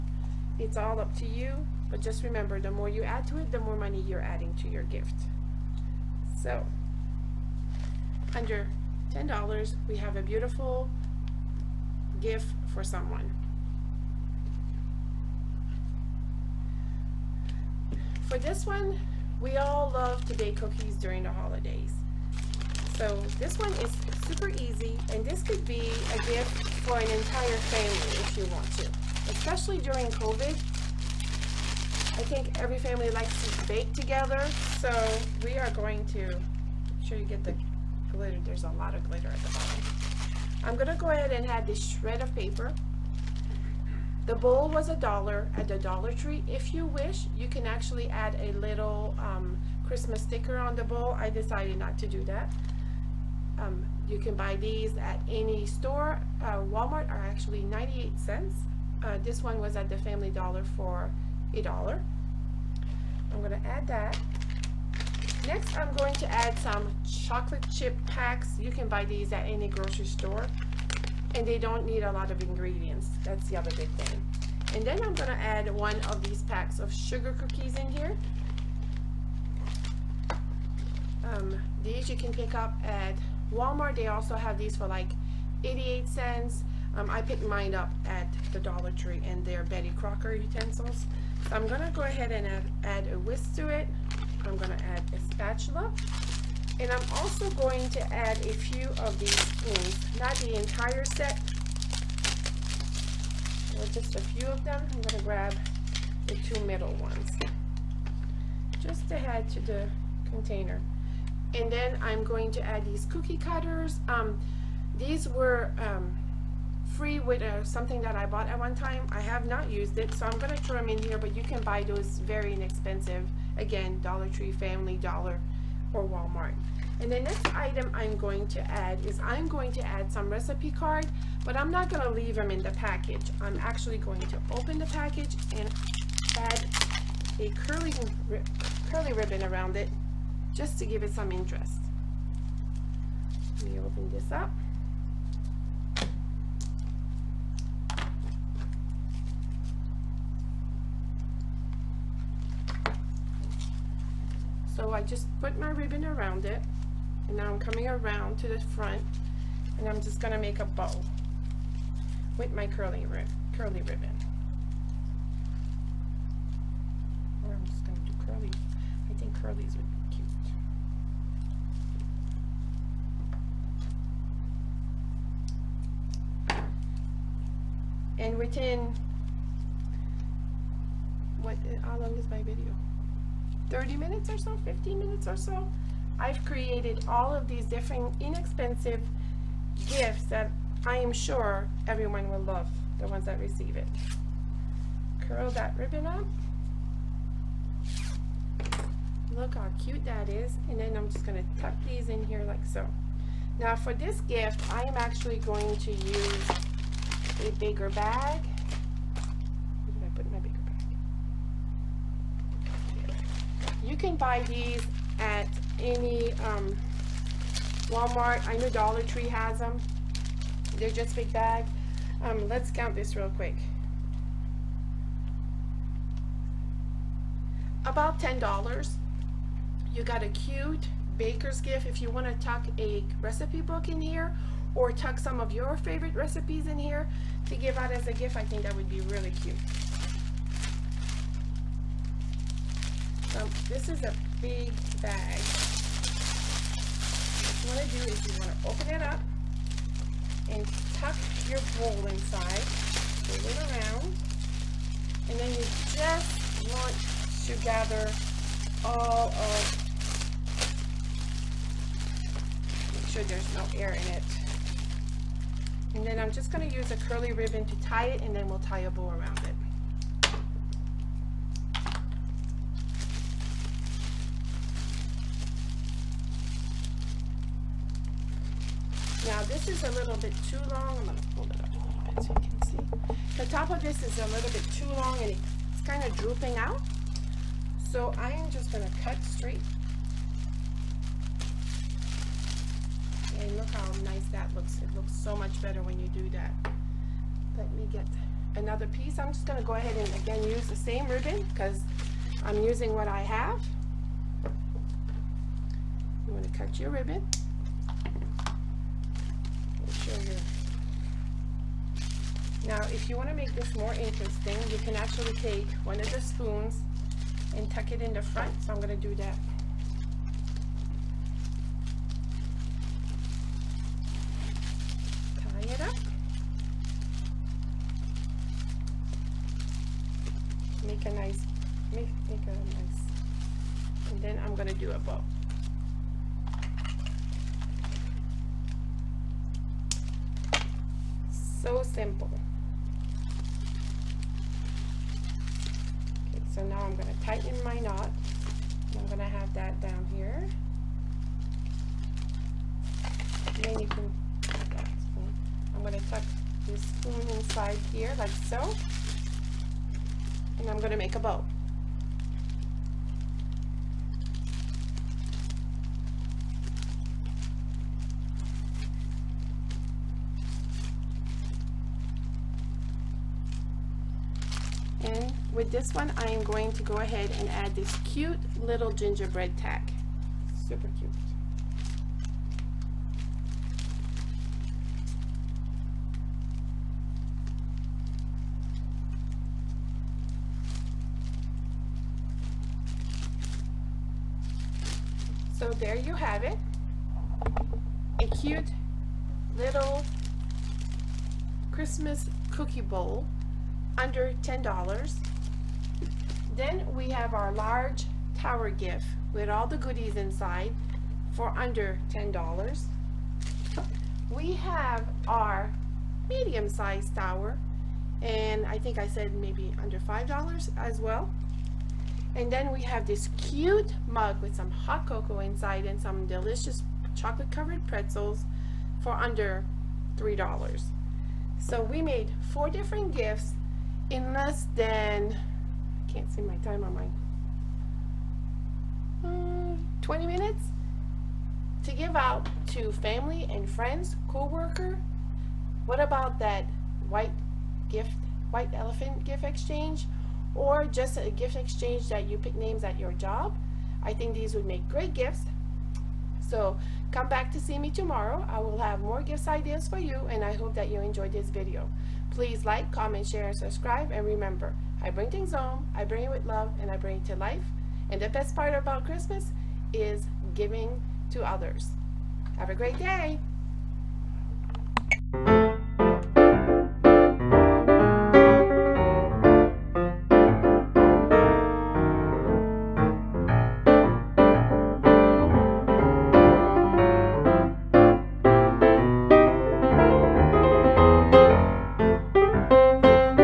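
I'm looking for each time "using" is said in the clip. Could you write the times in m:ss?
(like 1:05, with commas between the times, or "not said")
5:02.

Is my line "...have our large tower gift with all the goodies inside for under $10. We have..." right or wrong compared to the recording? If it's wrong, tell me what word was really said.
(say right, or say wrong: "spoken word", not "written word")
right.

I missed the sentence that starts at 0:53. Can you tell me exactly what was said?
Um, you can buy these at any store.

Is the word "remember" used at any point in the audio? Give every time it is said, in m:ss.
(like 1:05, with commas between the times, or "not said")
0:02, 7:44.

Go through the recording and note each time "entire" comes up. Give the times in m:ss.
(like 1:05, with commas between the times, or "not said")
0:27, 1:40.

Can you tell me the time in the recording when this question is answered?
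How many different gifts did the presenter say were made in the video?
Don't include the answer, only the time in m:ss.
7:12.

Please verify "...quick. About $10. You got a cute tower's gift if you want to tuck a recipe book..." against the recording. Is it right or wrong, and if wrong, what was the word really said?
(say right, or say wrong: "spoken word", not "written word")
wrong: "baker", not "tower".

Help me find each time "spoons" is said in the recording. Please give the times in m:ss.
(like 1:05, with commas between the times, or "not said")
1:39, 5:16, 5:56.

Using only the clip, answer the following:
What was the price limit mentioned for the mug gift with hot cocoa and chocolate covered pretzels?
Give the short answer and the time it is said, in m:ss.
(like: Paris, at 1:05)
under $3, at 7:09.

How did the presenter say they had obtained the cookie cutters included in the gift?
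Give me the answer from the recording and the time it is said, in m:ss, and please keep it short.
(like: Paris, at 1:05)
free, at 1:56.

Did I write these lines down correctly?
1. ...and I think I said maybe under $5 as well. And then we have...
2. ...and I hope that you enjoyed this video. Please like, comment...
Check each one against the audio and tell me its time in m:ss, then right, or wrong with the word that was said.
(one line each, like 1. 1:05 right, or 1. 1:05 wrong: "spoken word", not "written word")
1. 6:58 right
2. 7:40 right.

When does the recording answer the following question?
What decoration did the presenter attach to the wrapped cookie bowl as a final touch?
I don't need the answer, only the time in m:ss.
6:18.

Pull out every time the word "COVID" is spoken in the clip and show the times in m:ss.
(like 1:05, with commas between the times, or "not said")
0:30.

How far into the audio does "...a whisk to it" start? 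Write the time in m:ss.
1:33.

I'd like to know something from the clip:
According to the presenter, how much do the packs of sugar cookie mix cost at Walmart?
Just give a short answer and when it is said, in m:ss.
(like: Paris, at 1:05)
88 cents, at 1:25.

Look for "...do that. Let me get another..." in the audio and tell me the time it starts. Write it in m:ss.
4:56.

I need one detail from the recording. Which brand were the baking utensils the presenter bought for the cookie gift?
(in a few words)
Betty Crocker.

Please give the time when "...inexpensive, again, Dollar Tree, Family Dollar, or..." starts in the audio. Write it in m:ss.
2:02.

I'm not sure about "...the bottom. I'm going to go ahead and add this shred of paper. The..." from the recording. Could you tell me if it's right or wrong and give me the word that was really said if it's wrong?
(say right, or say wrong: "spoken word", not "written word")
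right.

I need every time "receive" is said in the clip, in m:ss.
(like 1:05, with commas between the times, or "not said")
3:13.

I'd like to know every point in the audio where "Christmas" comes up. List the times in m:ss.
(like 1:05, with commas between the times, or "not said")
0:49, 6:41, 7:49.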